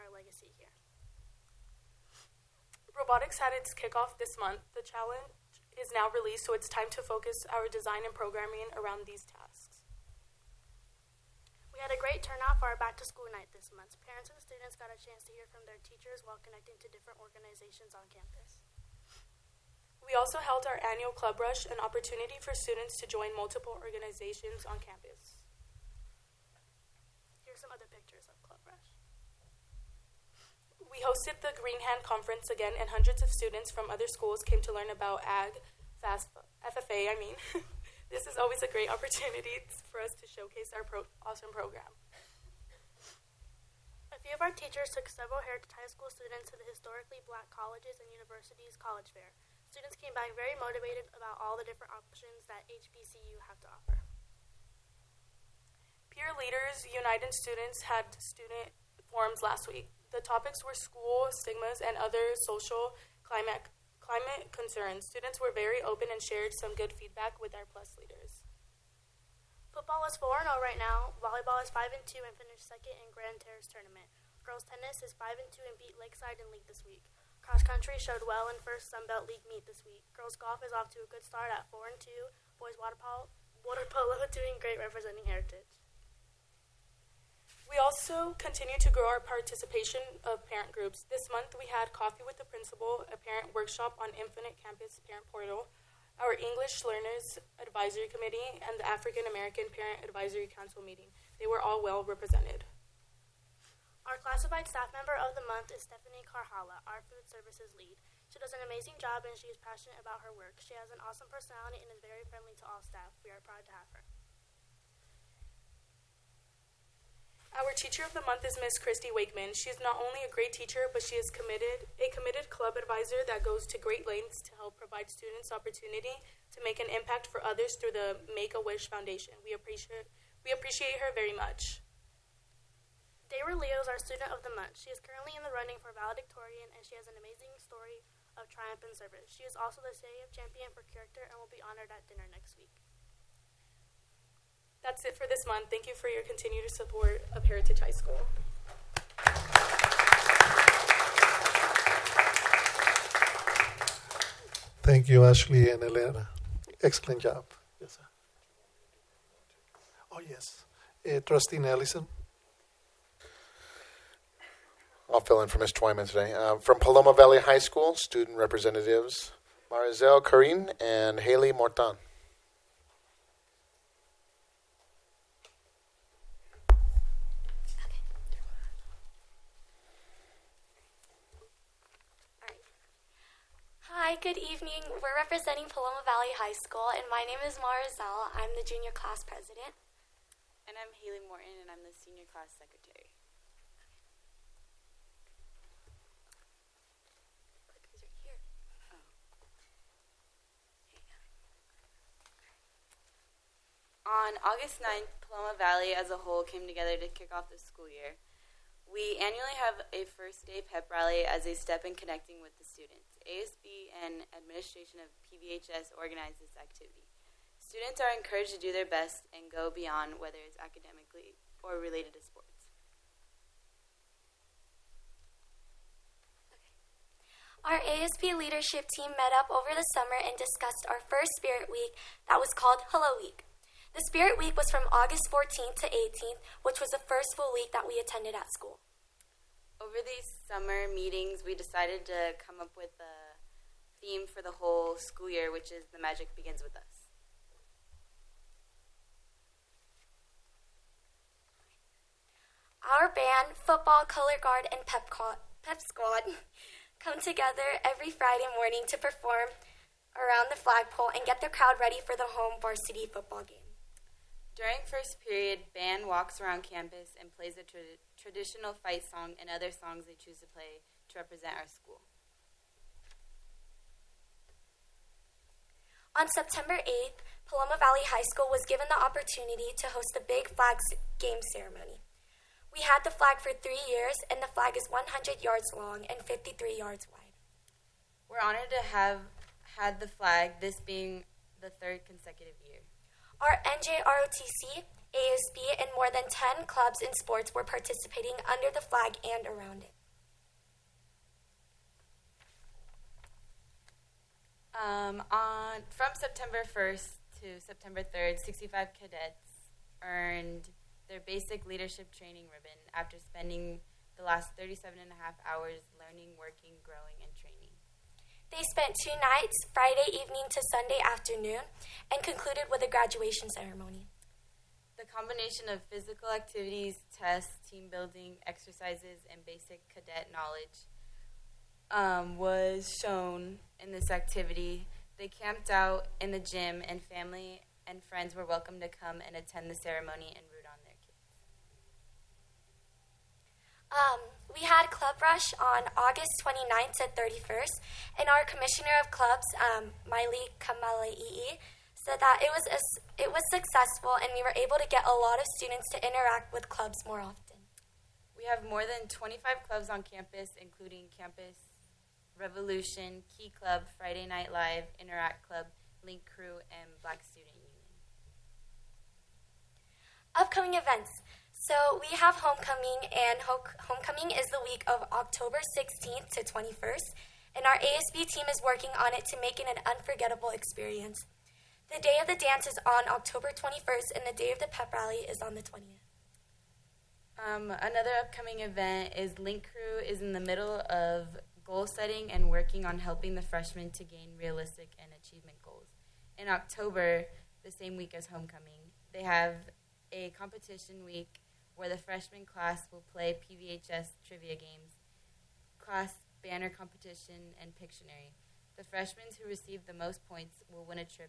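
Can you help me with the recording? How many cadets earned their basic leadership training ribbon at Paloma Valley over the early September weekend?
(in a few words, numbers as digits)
65.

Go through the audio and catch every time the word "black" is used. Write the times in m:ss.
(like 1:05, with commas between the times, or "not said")
0:47, 6:07.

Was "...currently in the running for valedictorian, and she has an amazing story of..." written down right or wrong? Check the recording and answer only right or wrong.
right.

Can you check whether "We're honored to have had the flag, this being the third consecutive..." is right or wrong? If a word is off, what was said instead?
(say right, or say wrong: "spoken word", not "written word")
right.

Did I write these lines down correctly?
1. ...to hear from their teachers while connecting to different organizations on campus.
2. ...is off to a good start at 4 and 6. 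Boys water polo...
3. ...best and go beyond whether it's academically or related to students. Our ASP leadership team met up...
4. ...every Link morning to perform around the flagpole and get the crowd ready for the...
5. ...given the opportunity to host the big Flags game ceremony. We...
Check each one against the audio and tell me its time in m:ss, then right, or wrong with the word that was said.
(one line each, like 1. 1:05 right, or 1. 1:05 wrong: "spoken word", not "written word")
1. 0:15 right
2. 1:20 wrong: "2", not "6"
3. 3:38 wrong: "sports", not "students"
4. 4:17 wrong: "Friday", not "Link"
5. 4:38 right.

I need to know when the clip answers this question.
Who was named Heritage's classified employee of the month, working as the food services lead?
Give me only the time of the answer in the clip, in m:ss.
1:45.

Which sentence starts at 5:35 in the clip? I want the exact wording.
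They camped out in the gym, and family and friends were welcome to come and attend the ceremony and.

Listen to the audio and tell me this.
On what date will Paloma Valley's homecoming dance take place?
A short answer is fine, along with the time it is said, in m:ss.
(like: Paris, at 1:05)
October 21st, at 6:23.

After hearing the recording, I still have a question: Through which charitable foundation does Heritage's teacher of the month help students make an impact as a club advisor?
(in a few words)
Make a Wish Foundation.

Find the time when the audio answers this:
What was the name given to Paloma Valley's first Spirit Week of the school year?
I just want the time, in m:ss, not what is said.
3:52.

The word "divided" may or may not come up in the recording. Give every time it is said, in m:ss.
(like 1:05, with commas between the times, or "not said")
not said.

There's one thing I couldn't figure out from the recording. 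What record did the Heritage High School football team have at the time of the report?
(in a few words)
4-0.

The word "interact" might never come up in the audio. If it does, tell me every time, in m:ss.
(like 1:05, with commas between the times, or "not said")
5:56, 6:05.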